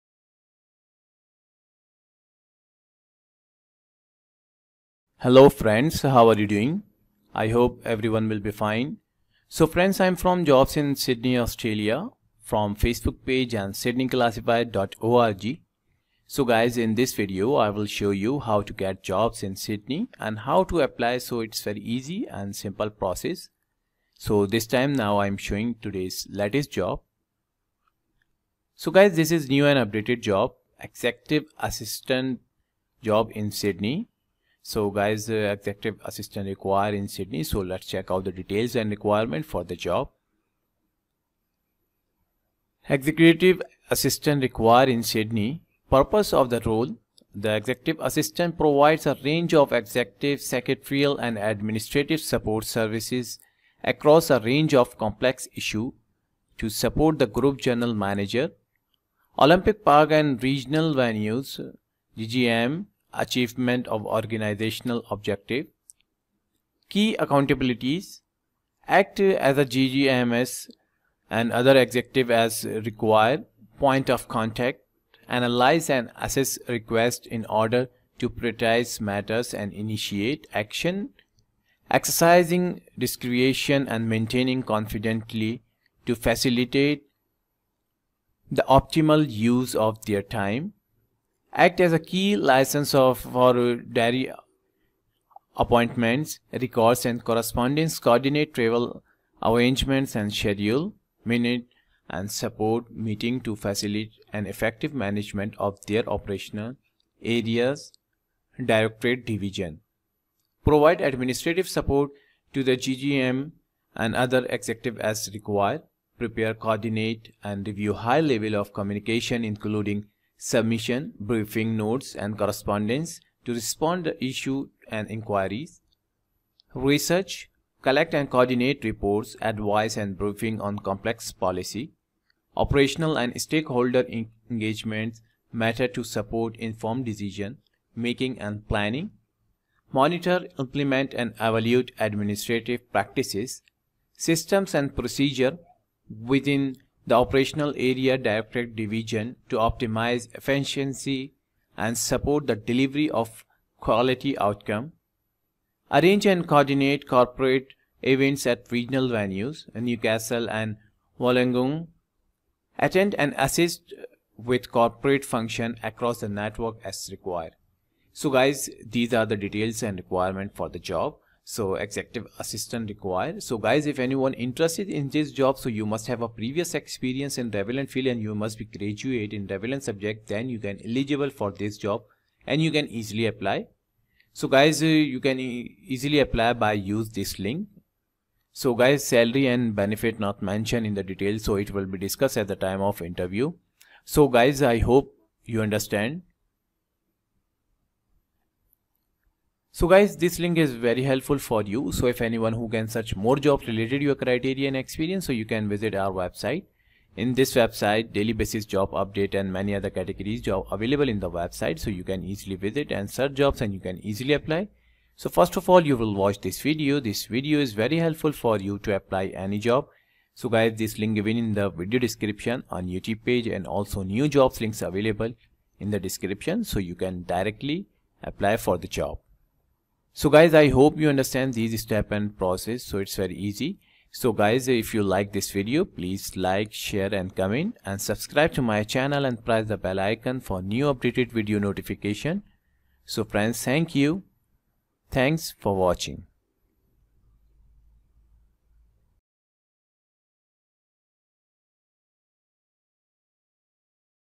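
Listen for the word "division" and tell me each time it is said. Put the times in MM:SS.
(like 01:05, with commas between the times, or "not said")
01:49, 02:28.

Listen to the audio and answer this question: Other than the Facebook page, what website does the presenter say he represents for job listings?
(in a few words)
sydneyclassified.org.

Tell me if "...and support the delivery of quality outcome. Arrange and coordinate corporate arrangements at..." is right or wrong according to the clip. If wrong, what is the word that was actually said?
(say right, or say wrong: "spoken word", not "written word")
wrong: "events", not "arrangements".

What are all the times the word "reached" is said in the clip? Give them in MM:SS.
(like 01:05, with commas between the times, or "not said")
not said.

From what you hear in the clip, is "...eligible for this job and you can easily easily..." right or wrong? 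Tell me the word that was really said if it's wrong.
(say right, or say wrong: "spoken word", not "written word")
wrong: "apply", not "easily".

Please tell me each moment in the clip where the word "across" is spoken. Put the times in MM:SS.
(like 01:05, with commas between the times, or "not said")
00:53, 02:45.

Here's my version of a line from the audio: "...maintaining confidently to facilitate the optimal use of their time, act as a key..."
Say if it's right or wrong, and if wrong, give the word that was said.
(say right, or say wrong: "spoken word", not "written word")
right.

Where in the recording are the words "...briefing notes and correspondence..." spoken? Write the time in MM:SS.
02:01.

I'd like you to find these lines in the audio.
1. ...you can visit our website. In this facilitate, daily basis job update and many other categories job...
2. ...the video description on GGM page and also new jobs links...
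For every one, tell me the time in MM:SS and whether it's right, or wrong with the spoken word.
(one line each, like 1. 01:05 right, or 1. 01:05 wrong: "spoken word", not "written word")
1. 03:25 wrong: "website", not "facilitate"
2. 03:41 wrong: "YouTube", not "GGM".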